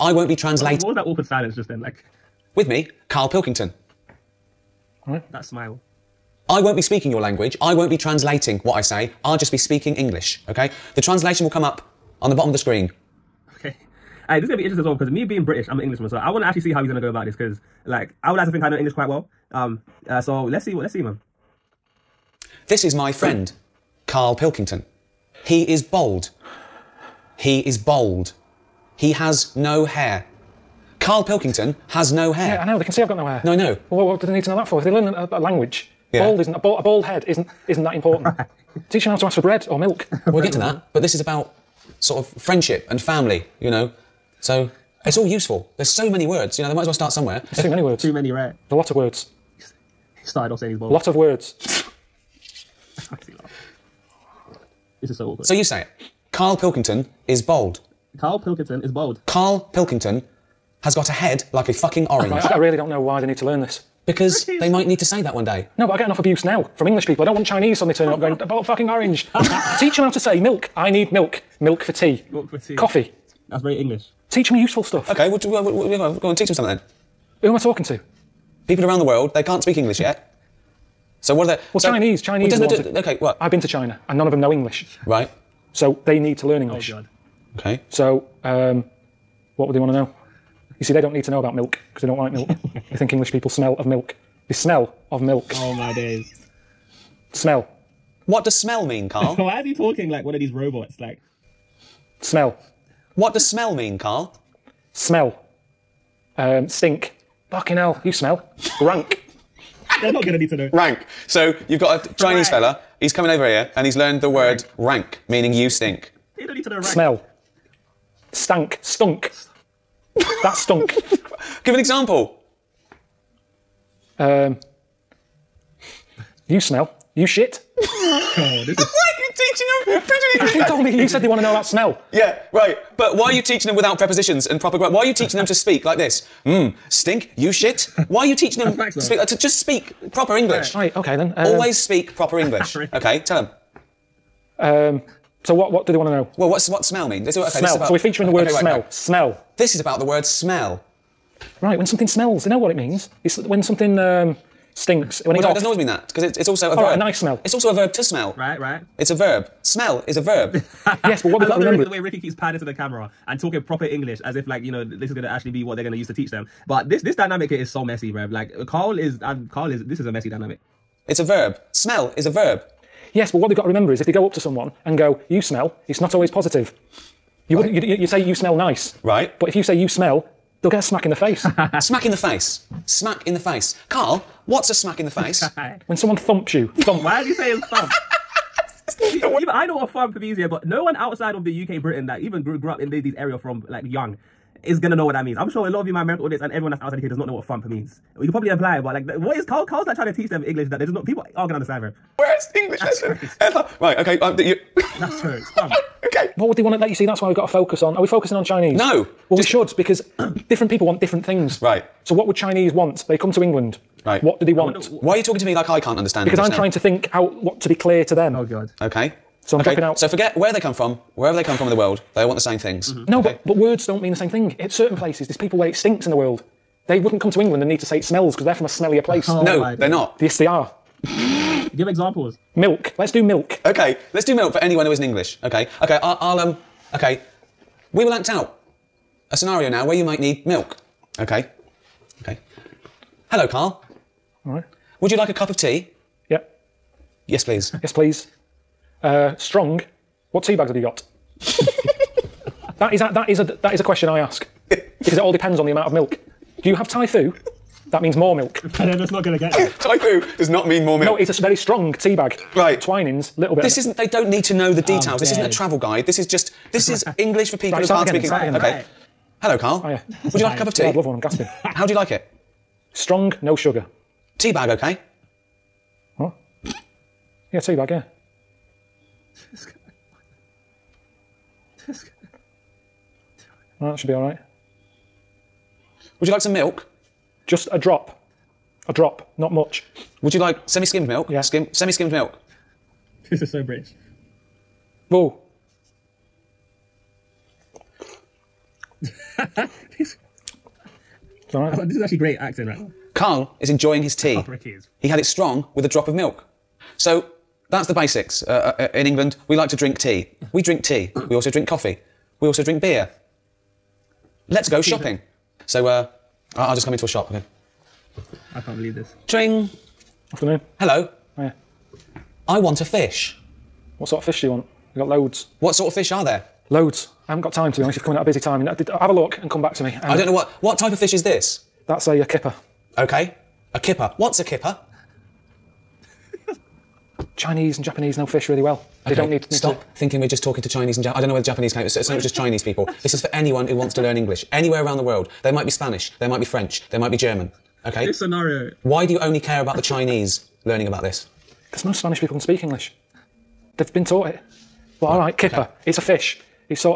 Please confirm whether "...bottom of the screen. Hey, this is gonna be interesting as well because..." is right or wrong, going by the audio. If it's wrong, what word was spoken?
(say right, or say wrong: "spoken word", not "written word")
right.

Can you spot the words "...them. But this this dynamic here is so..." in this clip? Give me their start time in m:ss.
2:46.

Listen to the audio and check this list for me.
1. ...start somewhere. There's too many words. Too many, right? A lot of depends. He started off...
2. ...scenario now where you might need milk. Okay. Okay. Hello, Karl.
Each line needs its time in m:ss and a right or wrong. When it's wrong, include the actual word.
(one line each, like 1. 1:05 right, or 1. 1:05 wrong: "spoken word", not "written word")
1. 0:46 wrong: "words", not "depends"
2. 3:59 right.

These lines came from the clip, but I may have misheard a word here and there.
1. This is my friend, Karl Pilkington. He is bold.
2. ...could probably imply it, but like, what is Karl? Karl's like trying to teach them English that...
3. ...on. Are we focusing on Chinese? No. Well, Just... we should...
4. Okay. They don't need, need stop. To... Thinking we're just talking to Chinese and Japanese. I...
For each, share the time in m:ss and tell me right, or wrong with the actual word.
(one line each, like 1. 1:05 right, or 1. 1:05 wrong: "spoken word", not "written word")
1. 0:22 right
2. 3:18 right
3. 3:27 right
4. 5:39 right.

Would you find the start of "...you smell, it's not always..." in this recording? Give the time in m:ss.
2:55.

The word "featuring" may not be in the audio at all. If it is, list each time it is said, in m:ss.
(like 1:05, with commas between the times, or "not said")
2:28.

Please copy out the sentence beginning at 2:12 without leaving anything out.
But why are you teaching them without prepositions and proper?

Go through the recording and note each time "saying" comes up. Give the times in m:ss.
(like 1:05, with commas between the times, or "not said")
0:50, 3:07.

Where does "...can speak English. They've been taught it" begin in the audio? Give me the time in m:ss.
5:52.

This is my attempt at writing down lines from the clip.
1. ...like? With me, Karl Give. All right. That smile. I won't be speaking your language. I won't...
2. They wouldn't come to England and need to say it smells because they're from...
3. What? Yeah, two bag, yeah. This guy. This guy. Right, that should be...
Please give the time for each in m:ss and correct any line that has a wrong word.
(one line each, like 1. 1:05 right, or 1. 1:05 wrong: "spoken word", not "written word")
1. 0:01 wrong: "Pilkington", not "Give"
2. 3:46 right
3. 4:36 right.